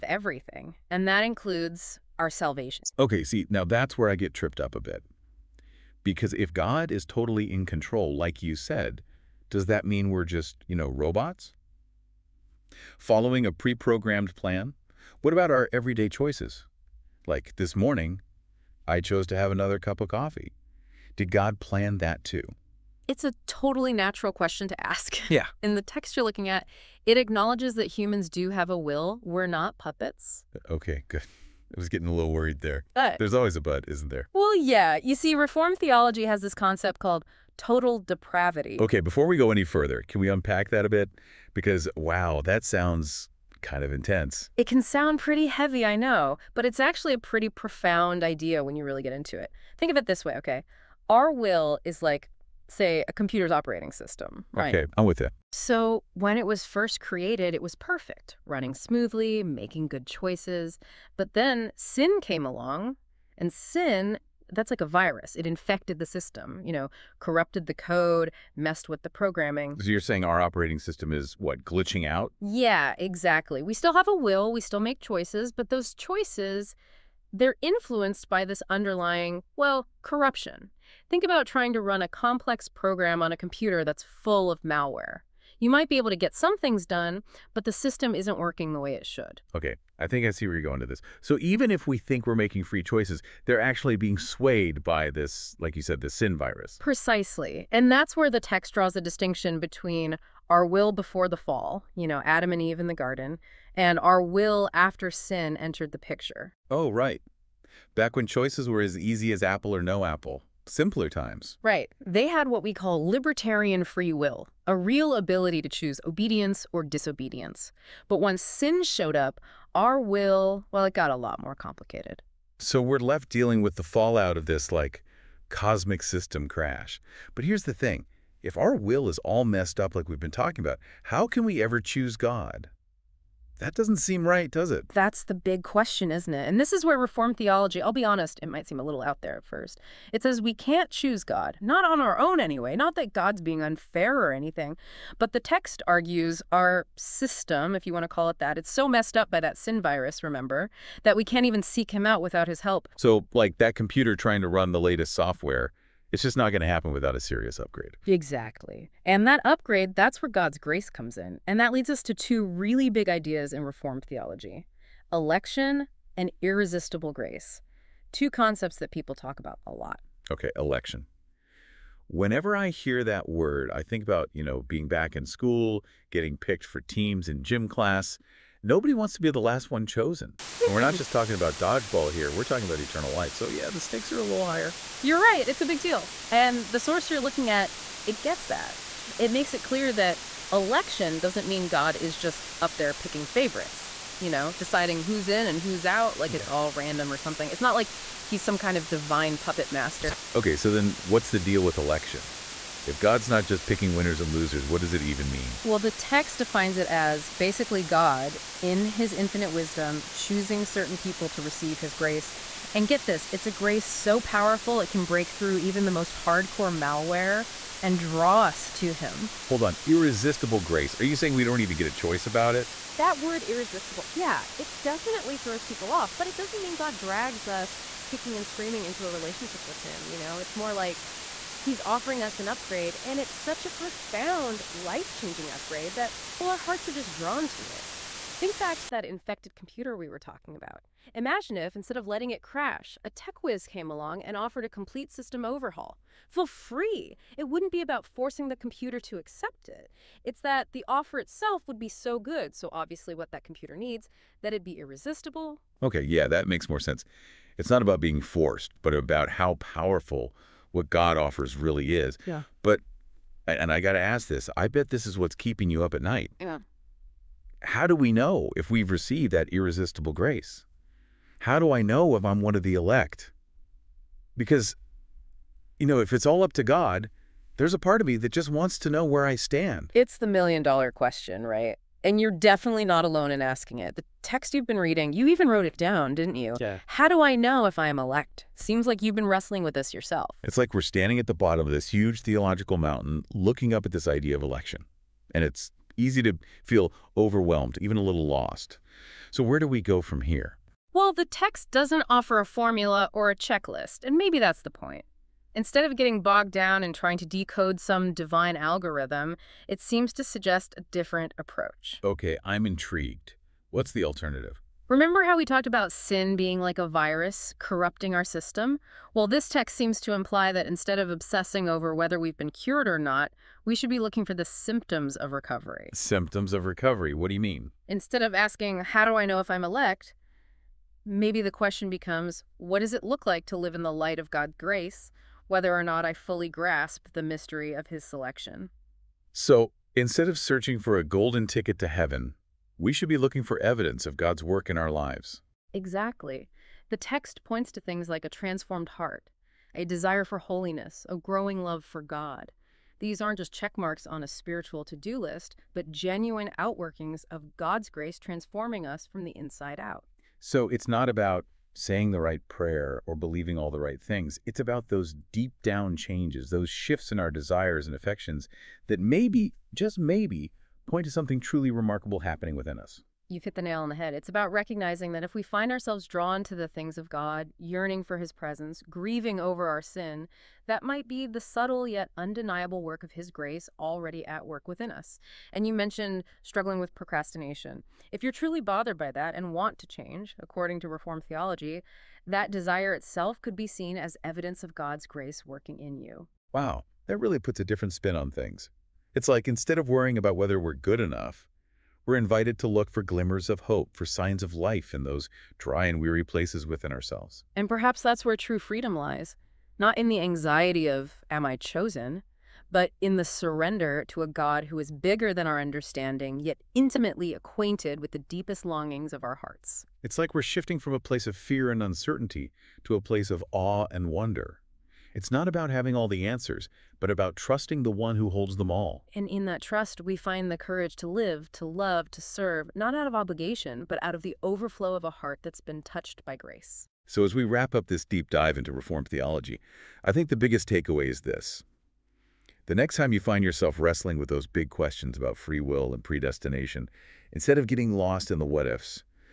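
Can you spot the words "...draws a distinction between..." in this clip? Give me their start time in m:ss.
1:38.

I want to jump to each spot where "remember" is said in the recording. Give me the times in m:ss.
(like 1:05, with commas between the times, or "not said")
2:30, 5:14.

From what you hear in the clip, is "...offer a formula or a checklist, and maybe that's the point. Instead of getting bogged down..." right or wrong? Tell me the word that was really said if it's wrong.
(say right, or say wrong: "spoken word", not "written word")
right.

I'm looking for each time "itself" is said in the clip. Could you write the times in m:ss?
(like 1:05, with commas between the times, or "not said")
4:11, 6:32.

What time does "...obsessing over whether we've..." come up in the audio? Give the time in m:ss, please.
5:21.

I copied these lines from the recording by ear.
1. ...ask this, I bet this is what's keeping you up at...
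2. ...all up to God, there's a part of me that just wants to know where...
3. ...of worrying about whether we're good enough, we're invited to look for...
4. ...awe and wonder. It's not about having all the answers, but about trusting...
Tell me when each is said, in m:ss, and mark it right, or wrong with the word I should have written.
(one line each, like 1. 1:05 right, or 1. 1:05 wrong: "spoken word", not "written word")
1. 4:23 right
2. 4:36 right
3. 6:39 right
4. 7:03 right.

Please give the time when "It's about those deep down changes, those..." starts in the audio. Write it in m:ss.
6:04.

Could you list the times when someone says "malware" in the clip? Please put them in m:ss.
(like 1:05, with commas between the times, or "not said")
1:24, 3:36.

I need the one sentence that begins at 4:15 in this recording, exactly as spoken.
Okay, yeah, that makes more sense.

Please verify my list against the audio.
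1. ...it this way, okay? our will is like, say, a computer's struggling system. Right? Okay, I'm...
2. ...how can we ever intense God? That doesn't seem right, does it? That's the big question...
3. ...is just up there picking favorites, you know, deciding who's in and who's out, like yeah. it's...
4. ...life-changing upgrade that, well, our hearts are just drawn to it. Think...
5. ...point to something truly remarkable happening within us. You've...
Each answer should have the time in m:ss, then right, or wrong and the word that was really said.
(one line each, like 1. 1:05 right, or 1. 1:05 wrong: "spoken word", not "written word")
1. 0:49 wrong: "operating", not "struggling"
2. 2:11 wrong: "choose", not "intense"
3. 3:11 right
4. 3:54 right
5. 6:10 right.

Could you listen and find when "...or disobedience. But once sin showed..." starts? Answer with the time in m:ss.
1:56.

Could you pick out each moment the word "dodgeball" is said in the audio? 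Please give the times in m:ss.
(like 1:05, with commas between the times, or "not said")
3:01.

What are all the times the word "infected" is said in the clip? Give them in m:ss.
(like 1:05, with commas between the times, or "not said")
1:05, 3:59.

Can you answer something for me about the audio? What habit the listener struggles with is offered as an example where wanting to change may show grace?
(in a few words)
procrastination.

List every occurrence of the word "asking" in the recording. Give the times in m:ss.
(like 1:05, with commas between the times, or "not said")
4:43, 5:28.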